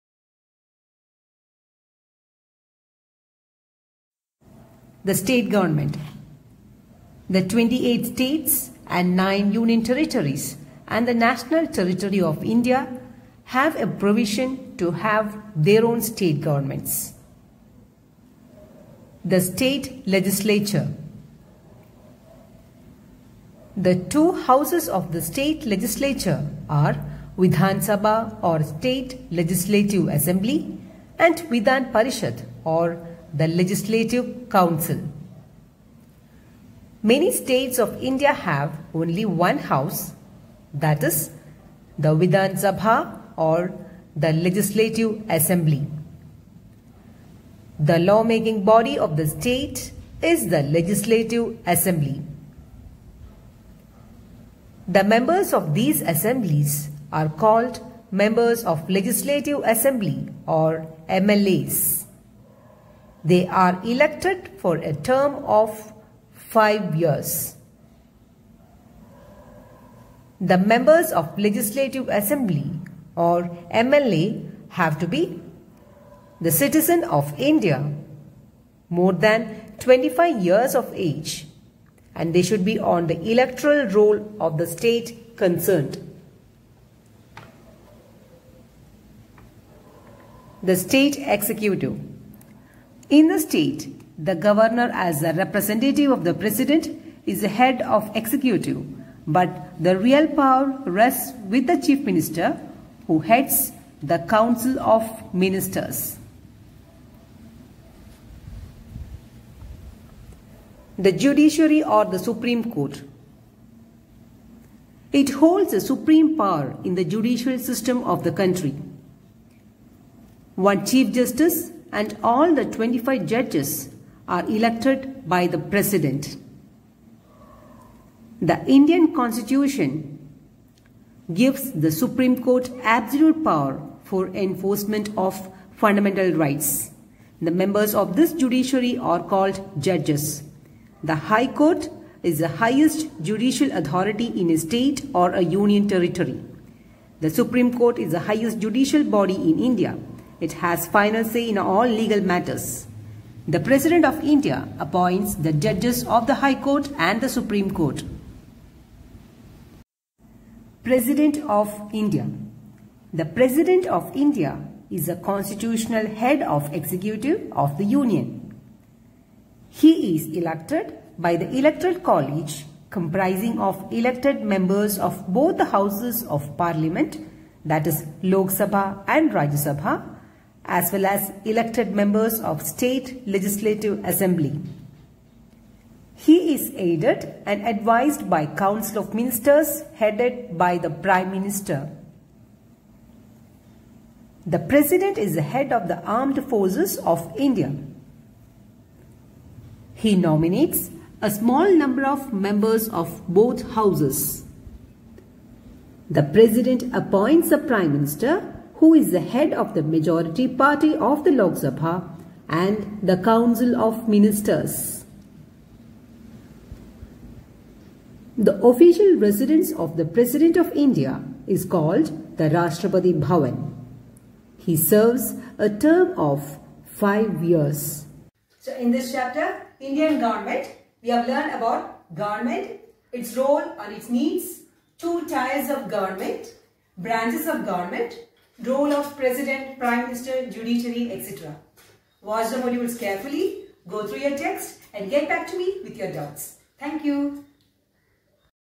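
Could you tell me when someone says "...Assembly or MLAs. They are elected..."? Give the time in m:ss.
0:59.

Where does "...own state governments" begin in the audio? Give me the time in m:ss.
0:15.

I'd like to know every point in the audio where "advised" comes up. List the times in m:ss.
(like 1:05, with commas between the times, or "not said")
3:07.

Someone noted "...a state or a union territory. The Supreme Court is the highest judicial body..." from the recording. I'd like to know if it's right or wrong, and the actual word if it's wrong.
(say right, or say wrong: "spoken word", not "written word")
right.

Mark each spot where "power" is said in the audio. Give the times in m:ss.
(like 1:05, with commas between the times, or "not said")
1:40, 1:56, 2:13.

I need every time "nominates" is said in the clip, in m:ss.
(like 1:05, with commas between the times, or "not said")
3:20.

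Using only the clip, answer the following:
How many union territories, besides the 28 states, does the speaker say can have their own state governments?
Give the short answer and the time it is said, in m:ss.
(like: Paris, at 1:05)
9, at 0:09.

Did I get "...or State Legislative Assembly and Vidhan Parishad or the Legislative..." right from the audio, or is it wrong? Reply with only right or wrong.
right.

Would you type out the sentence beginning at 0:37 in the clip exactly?
Many states of India have only one house, that is, the Vidhan Sabha or the Legislative Assembly.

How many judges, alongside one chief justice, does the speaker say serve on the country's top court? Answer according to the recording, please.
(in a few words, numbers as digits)
25.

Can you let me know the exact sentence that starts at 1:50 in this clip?
The judiciary or the supreme court.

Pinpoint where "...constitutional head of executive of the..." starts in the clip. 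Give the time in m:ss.
2:45.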